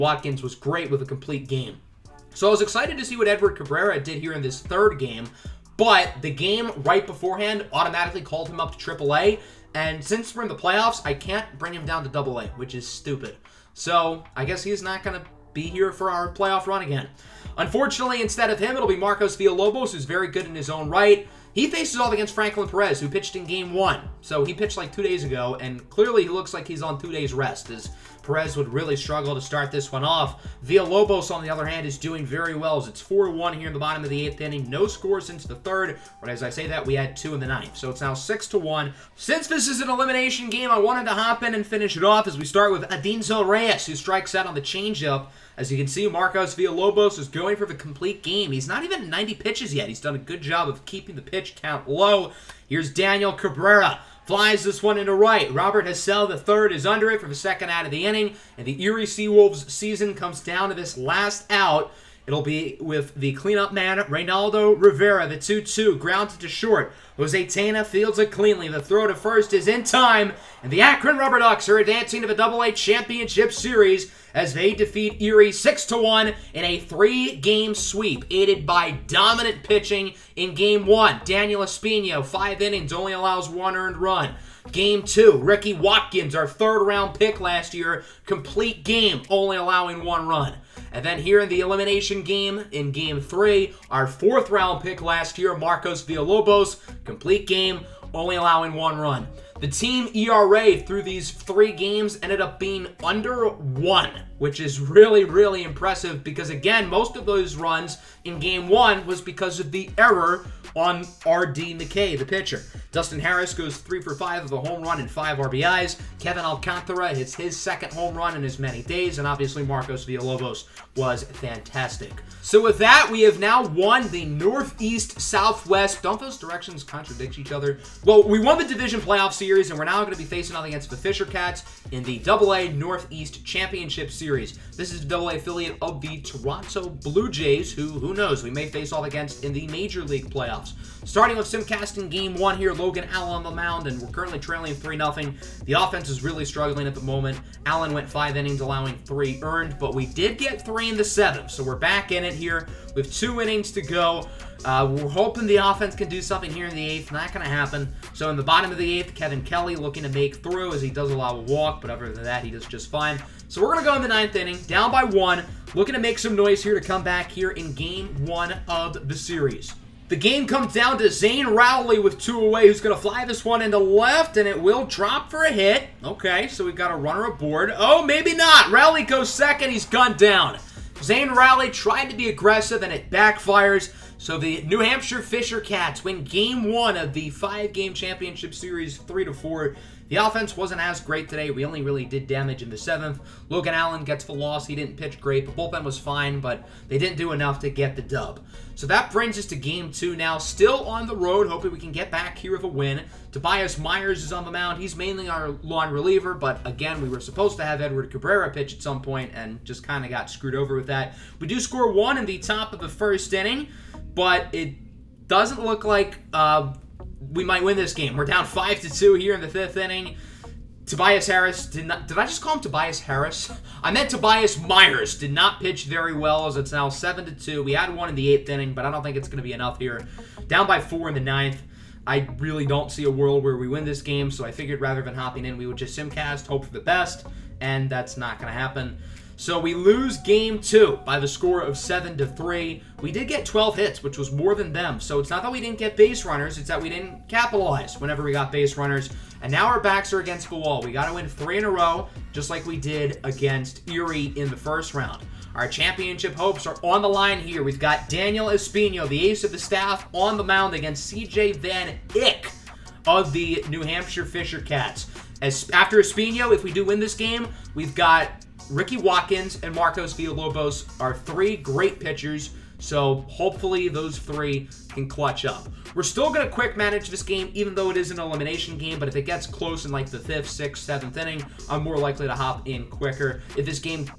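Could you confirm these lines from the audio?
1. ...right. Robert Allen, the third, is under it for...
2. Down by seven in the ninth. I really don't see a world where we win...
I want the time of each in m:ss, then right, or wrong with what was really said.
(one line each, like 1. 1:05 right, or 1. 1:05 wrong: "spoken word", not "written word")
1. 0:55 wrong: "Hassell", not "Allen"
2. 3:50 wrong: "four", not "seven".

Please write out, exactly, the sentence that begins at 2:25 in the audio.
The offense is really struggling at the moment.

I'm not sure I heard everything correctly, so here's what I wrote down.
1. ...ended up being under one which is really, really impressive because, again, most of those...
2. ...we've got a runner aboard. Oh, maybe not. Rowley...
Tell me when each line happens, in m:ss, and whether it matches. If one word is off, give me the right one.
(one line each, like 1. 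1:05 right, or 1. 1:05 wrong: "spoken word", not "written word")
1. 1:42 right
2. 2:56 right.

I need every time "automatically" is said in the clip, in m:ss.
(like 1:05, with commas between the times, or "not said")
0:07.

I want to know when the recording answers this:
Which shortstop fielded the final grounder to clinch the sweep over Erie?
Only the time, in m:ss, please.
1:07.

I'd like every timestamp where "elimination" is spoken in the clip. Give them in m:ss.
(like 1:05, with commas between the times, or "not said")
0:39, 1:31, 4:38.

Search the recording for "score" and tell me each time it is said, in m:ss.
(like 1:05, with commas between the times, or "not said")
0:34, 3:31, 4:01.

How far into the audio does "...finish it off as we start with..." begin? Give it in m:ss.
0:41.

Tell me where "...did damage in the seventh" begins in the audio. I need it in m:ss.
3:12.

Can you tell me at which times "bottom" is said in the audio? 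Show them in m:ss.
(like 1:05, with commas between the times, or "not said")
0:33, 2:38.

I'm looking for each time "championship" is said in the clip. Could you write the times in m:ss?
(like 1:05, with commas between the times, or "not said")
1:12, 2:13, 3:07, 4:15.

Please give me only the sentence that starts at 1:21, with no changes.
Daniel Espino, five innings, only allows one earned run.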